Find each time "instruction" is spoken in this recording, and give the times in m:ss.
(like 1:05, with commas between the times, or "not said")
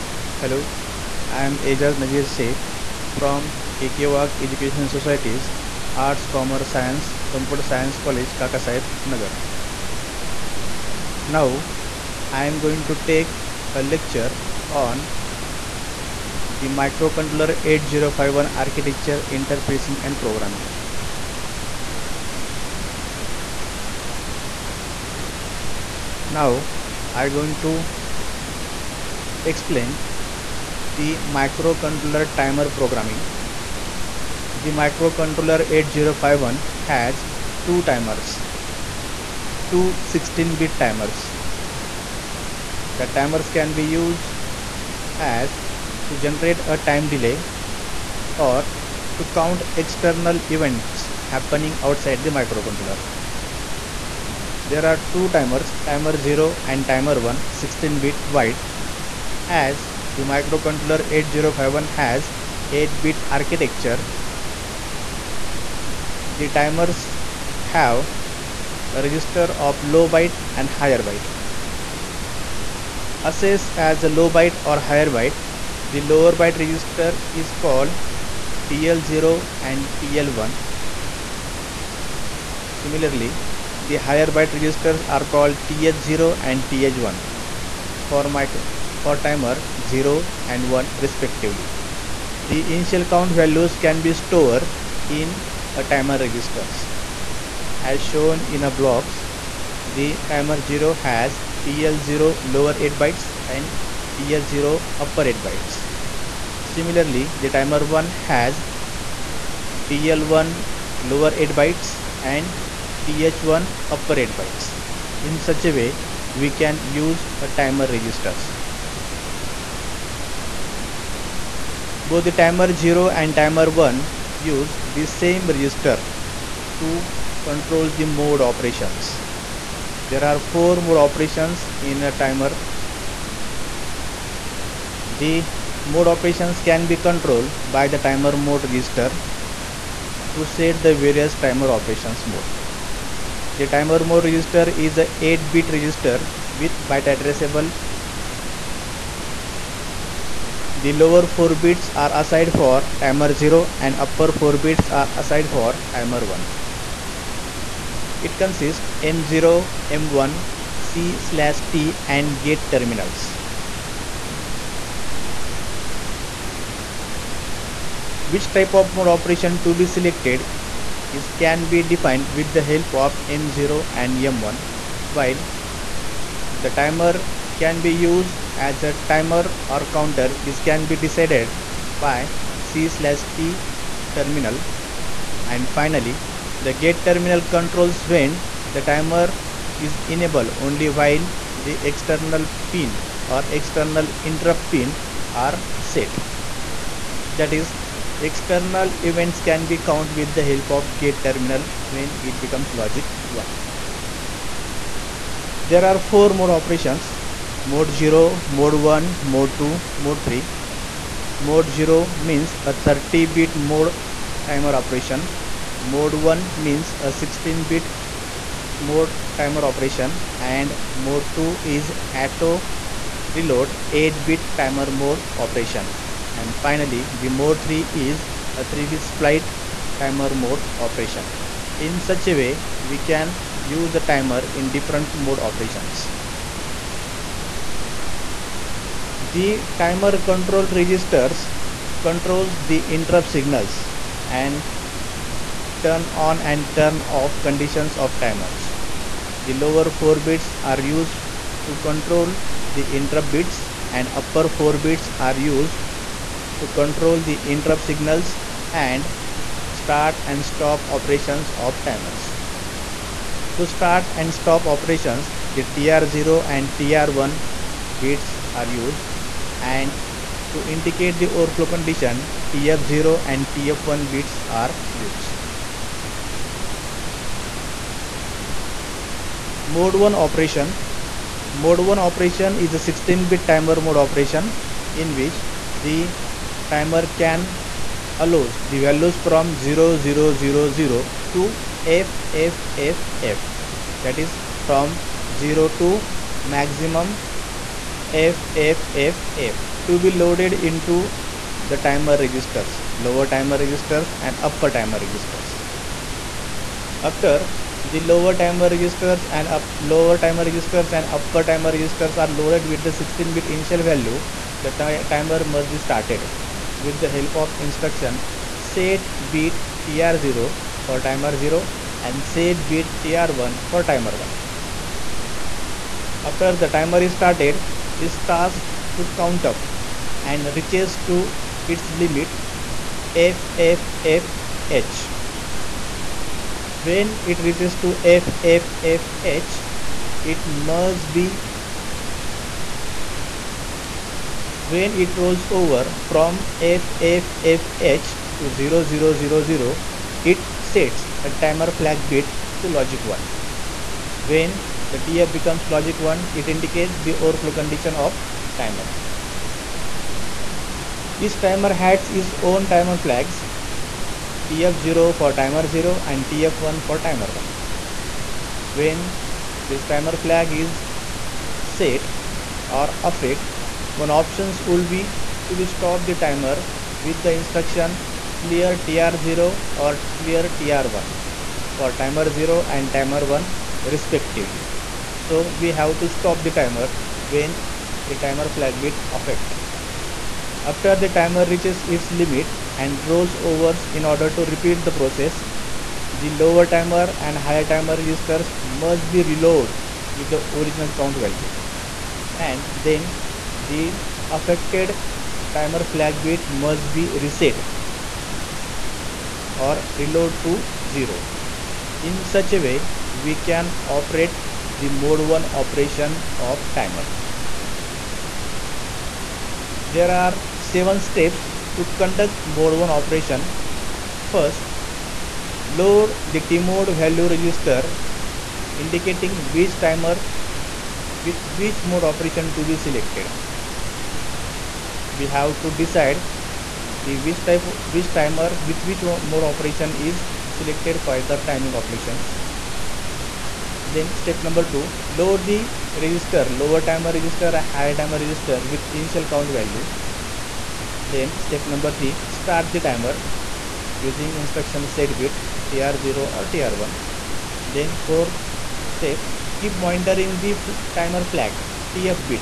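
5:17, 6:17, 7:34.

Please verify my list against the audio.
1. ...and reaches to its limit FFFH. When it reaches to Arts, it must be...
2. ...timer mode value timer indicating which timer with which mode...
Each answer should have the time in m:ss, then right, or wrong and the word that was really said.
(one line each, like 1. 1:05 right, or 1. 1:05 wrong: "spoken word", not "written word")
1. 5:30 wrong: "FFFH", not "Arts"
2. 7:06 wrong: "register", not "timer".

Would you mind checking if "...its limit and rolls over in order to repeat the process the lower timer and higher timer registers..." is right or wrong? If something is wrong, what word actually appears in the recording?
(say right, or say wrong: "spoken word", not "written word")
right.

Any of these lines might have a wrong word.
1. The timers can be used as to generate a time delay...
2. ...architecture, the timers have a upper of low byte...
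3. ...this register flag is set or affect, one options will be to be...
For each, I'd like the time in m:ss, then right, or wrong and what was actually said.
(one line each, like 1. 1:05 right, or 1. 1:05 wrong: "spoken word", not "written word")
1. 0:42 right
2. 1:03 wrong: "register", not "upper"
3. 6:09 wrong: "timer", not "register".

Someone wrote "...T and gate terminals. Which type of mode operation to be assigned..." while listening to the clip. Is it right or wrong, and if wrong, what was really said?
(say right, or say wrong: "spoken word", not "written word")
wrong: "selected", not "assigned".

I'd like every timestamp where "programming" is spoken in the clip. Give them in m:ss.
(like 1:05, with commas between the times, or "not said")
0:20, 0:32.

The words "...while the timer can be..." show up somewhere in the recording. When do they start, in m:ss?
2:55.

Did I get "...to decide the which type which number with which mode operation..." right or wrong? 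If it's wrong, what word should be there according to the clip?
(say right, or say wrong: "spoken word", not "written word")
wrong: "timer", not "number".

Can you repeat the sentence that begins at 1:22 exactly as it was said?
Similarly, the higher byte registers are called TH0 and TH1 for micro for timer 0 and 1 respectively.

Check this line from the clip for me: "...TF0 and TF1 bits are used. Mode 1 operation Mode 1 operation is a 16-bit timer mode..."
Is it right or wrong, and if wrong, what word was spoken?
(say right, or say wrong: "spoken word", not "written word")
right.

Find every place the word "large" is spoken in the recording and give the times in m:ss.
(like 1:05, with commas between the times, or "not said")
not said.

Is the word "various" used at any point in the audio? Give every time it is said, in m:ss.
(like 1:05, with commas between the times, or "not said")
2:20.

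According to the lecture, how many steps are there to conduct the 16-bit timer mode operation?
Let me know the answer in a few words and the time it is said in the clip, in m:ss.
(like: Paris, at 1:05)
7, at 7:00.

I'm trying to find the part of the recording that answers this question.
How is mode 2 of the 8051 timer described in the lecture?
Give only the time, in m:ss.
3:42.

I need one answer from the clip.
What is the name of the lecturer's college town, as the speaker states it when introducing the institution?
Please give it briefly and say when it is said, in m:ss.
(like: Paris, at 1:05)
Kaka Saib, Nagar, at 0:08.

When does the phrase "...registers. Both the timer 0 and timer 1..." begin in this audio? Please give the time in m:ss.
1:57.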